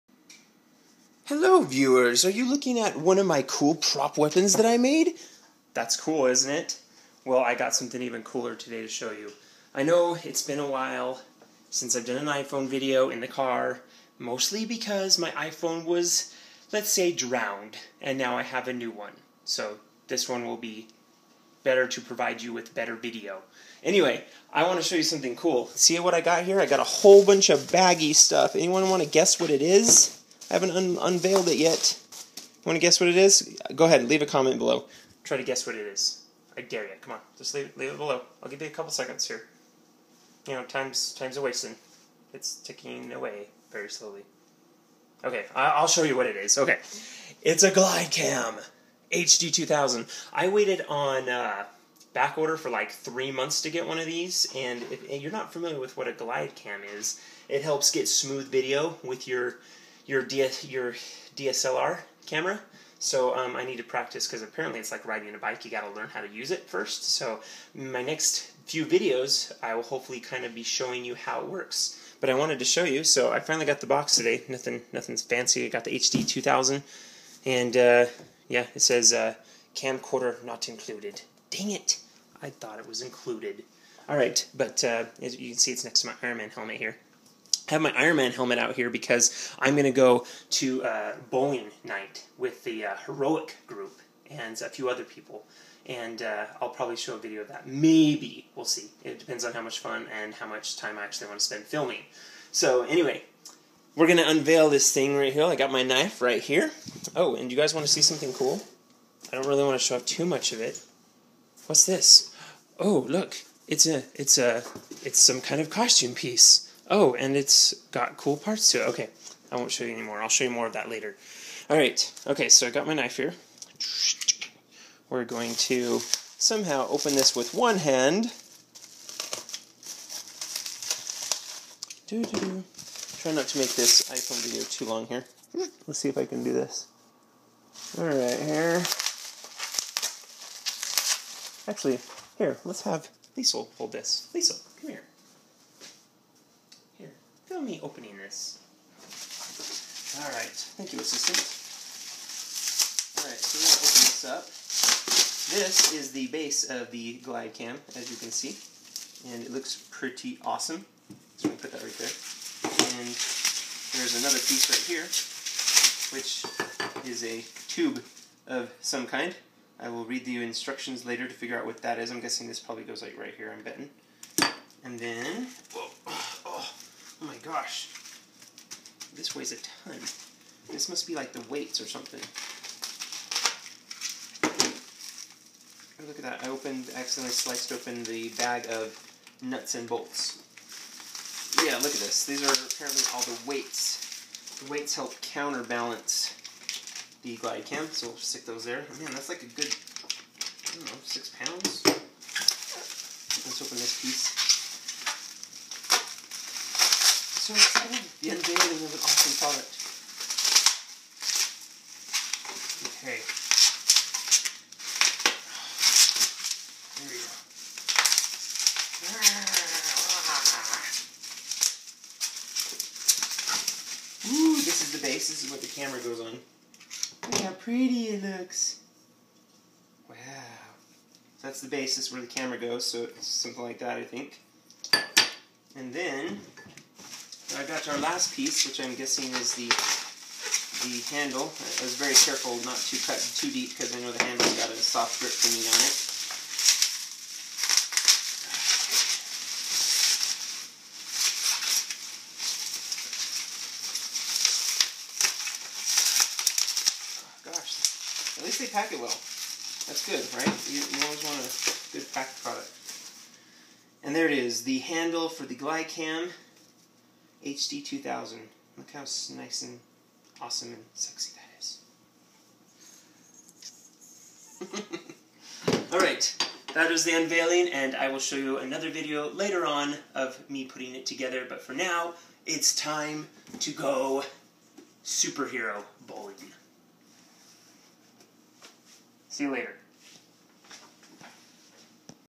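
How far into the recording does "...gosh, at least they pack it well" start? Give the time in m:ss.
4:17.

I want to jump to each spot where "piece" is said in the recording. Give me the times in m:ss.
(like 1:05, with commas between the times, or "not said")
1:56, 2:44, 3:24, 3:58.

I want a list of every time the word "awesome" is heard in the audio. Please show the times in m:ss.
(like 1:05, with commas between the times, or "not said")
2:40, 3:29, 4:30.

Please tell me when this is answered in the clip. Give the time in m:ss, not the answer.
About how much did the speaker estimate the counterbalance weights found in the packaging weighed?
3:21.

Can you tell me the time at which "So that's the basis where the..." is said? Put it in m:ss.
3:51.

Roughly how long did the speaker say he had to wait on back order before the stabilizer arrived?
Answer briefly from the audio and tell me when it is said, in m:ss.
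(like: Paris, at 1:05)
3 months, at 0:52.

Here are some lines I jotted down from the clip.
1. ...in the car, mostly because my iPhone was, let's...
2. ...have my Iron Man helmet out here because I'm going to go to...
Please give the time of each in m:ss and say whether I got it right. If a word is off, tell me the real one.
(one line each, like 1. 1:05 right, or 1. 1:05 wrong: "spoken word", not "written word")
1. 0:13 right
2. 1:27 right.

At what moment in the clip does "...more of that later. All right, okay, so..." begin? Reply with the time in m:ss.
2:00.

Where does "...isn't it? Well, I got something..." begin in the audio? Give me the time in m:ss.
0:06.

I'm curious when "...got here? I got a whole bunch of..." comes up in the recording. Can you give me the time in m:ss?
0:26.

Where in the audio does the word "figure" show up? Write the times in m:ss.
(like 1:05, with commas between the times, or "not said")
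2:51.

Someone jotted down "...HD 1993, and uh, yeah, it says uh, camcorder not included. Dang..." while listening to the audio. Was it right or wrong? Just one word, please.
wrong.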